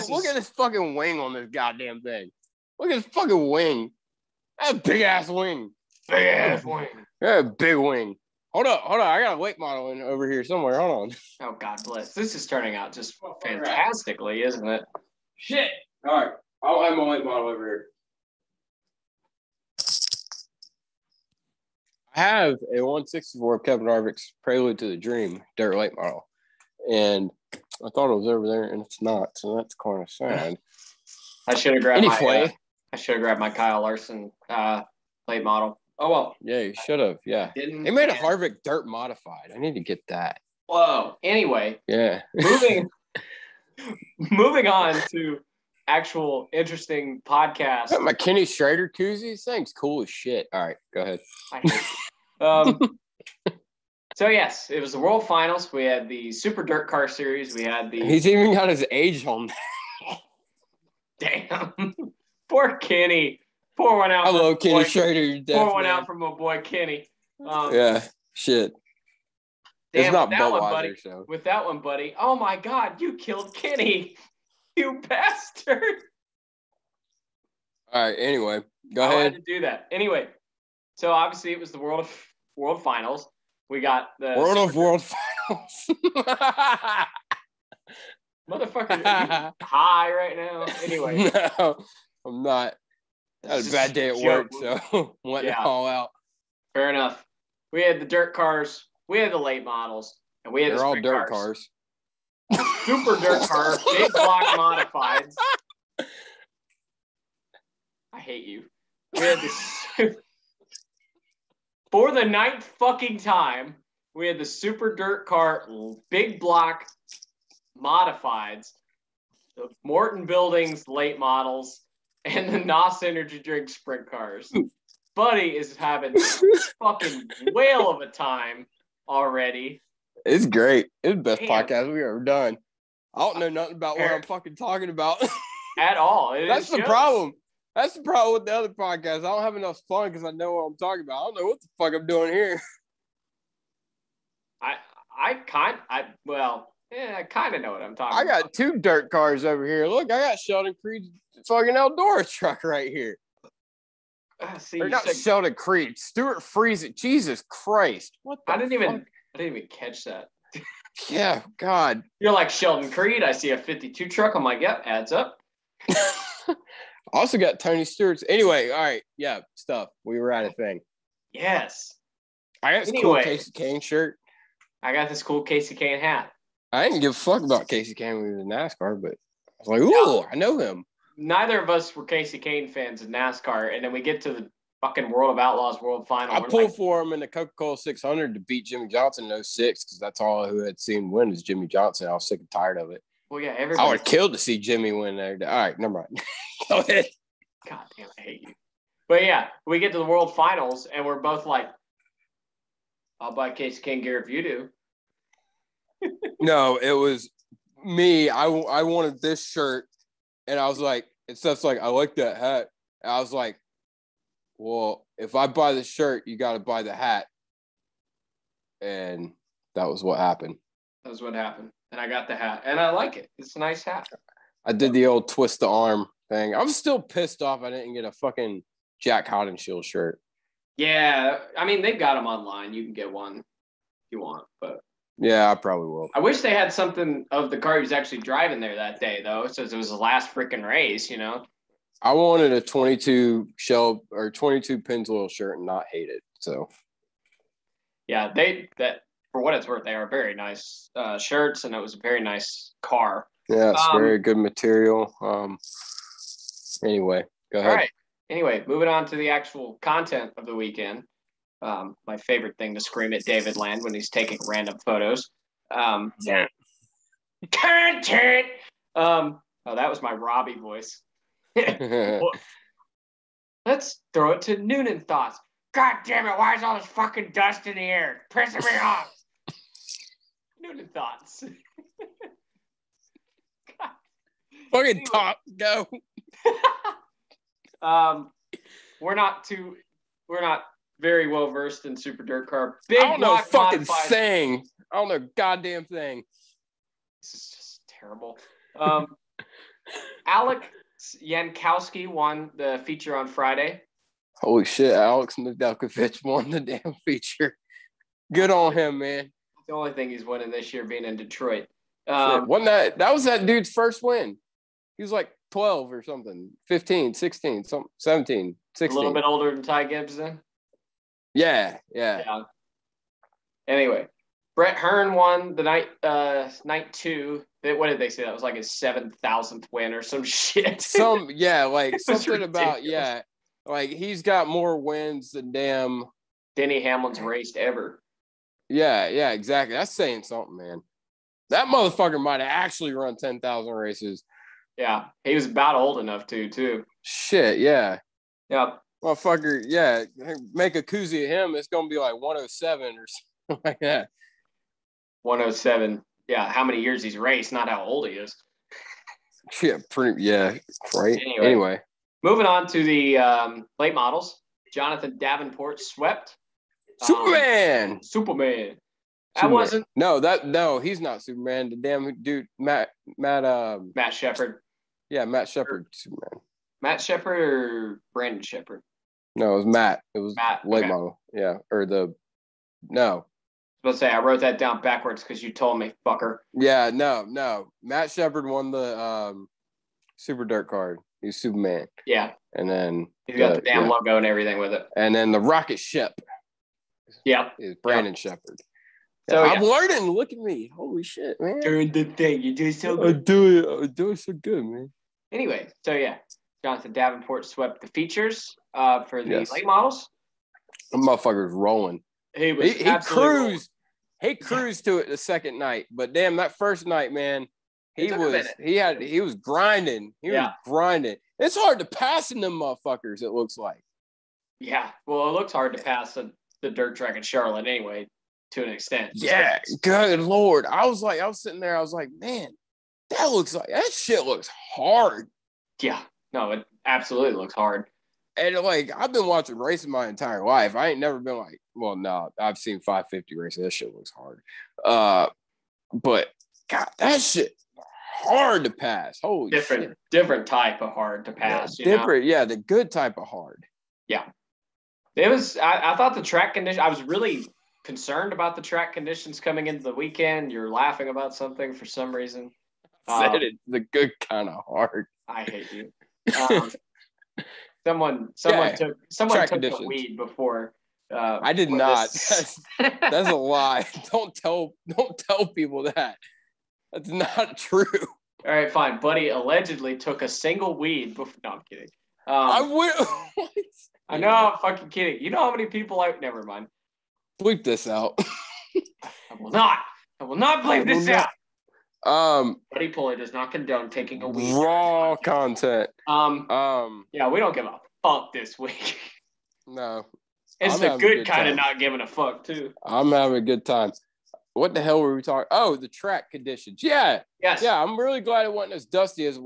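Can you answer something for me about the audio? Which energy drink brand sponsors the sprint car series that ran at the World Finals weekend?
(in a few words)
NOS.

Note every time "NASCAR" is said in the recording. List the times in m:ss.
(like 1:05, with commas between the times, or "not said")
2:58, 3:03.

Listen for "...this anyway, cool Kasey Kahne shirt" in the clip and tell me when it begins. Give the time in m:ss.
2:52.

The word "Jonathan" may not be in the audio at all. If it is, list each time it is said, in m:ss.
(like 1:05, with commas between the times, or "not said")
6:04, 6:46.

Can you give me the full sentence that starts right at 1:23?
We got the world Super of world finals.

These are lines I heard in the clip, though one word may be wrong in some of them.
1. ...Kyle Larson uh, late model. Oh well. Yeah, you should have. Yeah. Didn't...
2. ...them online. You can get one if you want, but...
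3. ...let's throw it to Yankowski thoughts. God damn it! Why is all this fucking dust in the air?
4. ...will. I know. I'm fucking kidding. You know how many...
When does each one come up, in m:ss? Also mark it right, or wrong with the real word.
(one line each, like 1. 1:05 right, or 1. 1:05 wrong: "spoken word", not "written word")
1. 0:33 right
2. 3:52 right
3. 4:33 wrong: "Noonan", not "Yankowski"
4. 8:02 right.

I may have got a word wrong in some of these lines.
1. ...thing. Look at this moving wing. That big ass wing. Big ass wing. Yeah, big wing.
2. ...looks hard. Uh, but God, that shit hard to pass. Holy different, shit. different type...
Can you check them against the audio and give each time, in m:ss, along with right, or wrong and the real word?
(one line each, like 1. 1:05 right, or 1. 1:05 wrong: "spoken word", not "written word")
1. 0:02 wrong: "fucking", not "moving"
2. 7:23 right.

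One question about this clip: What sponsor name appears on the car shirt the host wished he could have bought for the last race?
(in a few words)
Pennzoil.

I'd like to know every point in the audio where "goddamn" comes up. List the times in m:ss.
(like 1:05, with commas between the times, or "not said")
0:01, 4:55.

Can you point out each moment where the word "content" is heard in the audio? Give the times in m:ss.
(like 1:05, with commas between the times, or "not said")
4:19, 4:27, 8:15.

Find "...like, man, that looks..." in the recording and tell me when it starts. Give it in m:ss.
7:11.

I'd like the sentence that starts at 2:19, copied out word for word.
I don't have enough fun because I know what I'm talking about.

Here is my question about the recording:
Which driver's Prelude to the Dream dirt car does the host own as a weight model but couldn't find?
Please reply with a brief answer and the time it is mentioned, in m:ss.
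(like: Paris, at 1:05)
Kevin Harvick, at 0:23.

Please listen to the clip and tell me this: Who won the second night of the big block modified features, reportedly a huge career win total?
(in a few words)
Brett Hearn.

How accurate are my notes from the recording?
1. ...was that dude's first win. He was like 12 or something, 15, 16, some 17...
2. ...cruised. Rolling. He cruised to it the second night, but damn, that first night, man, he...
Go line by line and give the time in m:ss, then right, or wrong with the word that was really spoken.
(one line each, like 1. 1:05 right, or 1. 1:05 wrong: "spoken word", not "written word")
1. 5:13 right
2. 6:52 right.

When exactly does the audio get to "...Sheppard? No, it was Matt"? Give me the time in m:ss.
6:18.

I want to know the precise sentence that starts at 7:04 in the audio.
Yeah, well, it looks hard to pass the, the dirt track in Charlotte anyway, to an extent.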